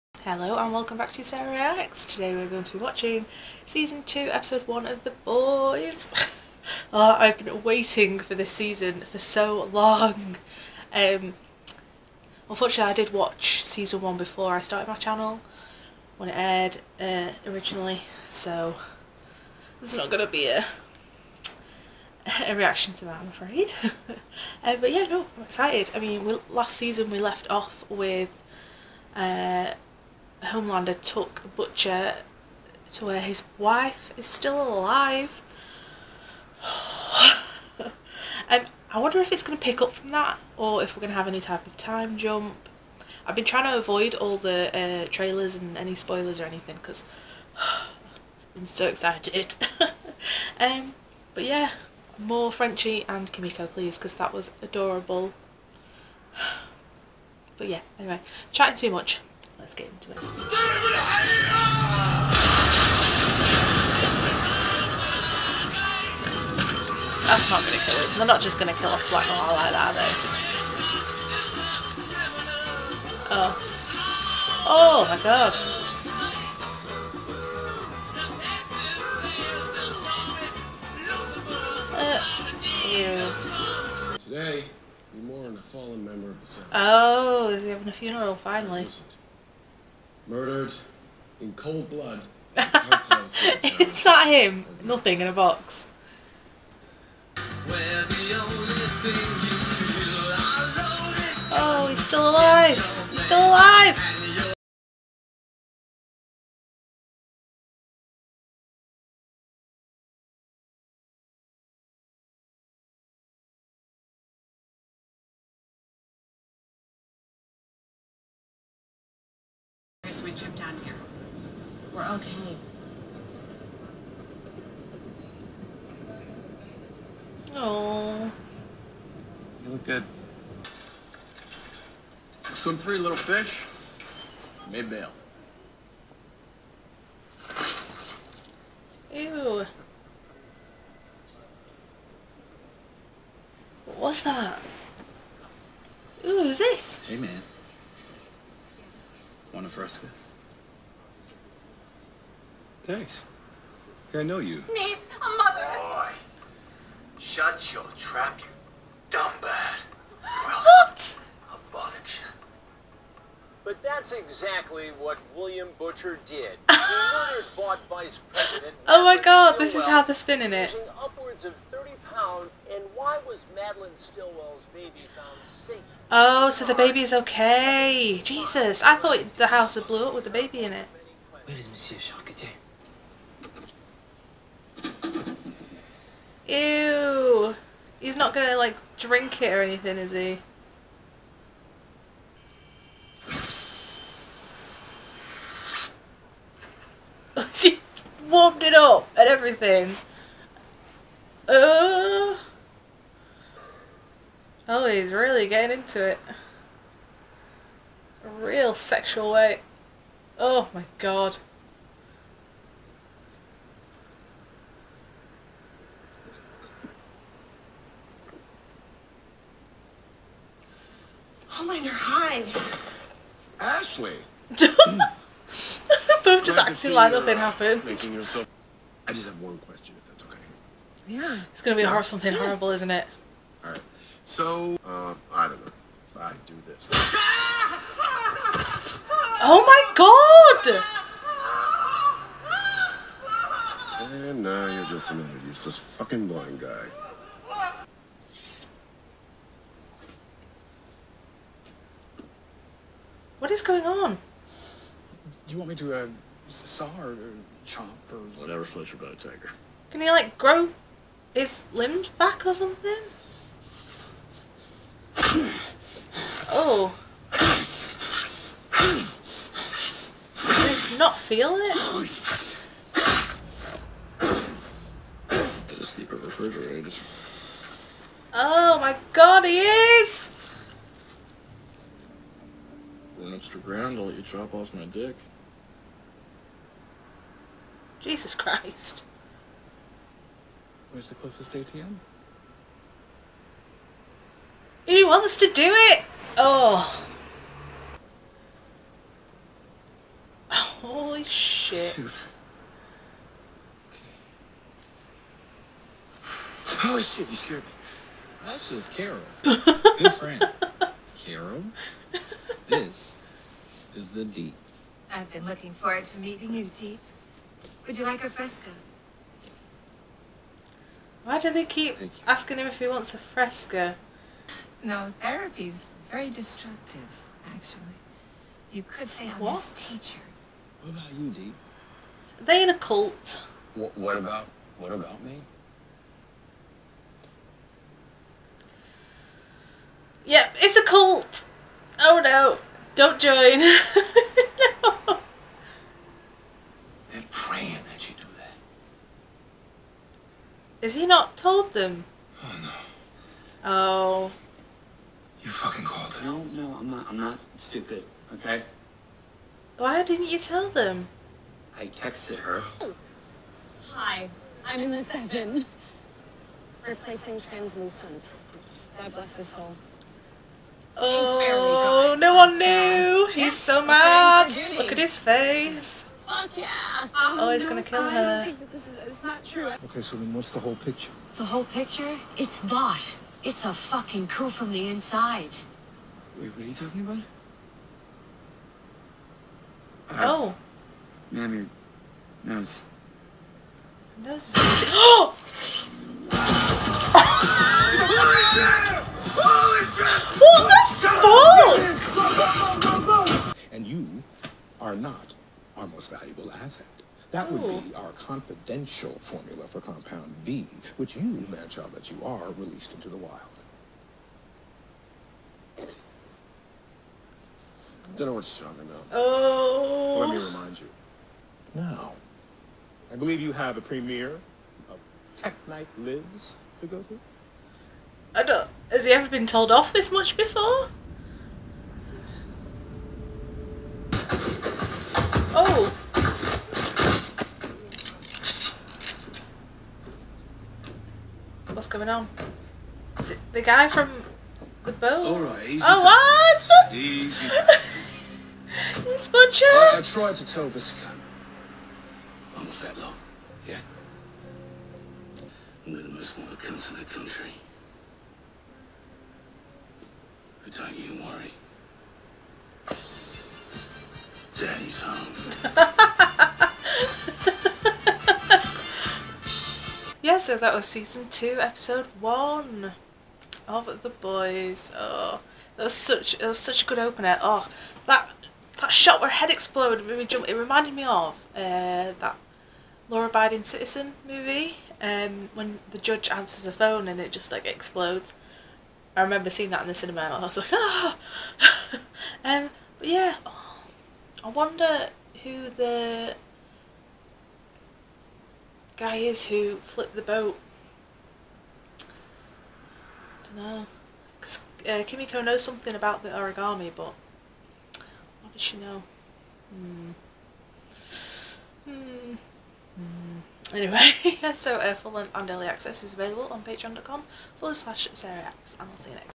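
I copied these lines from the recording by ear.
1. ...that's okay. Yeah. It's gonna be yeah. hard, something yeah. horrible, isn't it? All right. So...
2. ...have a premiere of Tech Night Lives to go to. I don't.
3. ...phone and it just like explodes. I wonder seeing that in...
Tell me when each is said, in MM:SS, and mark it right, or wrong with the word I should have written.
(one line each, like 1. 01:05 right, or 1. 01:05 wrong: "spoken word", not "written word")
1. 03:50 right
2. 07:03 right
3. 08:06 wrong: "remember", not "wonder".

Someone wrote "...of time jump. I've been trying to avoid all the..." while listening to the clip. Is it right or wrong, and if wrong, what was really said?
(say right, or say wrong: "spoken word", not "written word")
right.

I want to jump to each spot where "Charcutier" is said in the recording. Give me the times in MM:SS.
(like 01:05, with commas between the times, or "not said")
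03:01.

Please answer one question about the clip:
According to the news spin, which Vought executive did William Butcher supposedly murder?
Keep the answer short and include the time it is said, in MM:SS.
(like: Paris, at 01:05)
Madeline Stillwell, at 02:53.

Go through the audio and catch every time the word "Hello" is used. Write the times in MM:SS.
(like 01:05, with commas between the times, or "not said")
00:00.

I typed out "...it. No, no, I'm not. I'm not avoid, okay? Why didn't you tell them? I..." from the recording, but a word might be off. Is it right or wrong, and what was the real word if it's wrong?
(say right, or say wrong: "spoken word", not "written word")
wrong: "stupid", not "avoid".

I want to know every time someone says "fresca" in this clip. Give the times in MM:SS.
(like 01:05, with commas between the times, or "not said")
02:29, 05:18, 05:23.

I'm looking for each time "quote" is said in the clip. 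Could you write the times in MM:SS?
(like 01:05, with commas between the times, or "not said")
not said.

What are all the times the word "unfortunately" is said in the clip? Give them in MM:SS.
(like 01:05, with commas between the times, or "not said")
00:12.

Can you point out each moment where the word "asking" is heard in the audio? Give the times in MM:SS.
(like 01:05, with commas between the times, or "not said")
05:22.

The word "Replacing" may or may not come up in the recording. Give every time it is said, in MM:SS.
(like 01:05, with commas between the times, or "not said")
06:06.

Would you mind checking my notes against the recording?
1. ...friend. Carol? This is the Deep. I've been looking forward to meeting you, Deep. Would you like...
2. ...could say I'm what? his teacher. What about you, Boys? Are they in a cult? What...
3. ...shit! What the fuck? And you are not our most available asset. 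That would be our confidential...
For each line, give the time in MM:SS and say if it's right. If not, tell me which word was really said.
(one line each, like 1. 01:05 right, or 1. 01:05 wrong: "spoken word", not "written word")
1. 05:10 right
2. 05:28 wrong: "Dee", not "Boys"
3. 06:39 wrong: "valuable", not "available".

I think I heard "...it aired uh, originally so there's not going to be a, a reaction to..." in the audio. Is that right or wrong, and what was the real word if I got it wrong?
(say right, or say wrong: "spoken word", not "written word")
right.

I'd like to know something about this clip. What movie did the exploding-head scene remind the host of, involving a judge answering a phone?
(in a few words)
Law Abiding Citizen.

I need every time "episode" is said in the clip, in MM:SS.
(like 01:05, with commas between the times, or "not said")
00:04, 07:51.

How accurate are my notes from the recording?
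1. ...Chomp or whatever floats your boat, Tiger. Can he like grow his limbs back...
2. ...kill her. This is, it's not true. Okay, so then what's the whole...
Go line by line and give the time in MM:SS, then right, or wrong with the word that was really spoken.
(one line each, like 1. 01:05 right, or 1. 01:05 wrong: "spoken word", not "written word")
1. 04:17 right
2. 06:17 right.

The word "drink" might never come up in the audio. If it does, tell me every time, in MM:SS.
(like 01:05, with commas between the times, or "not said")
03:08.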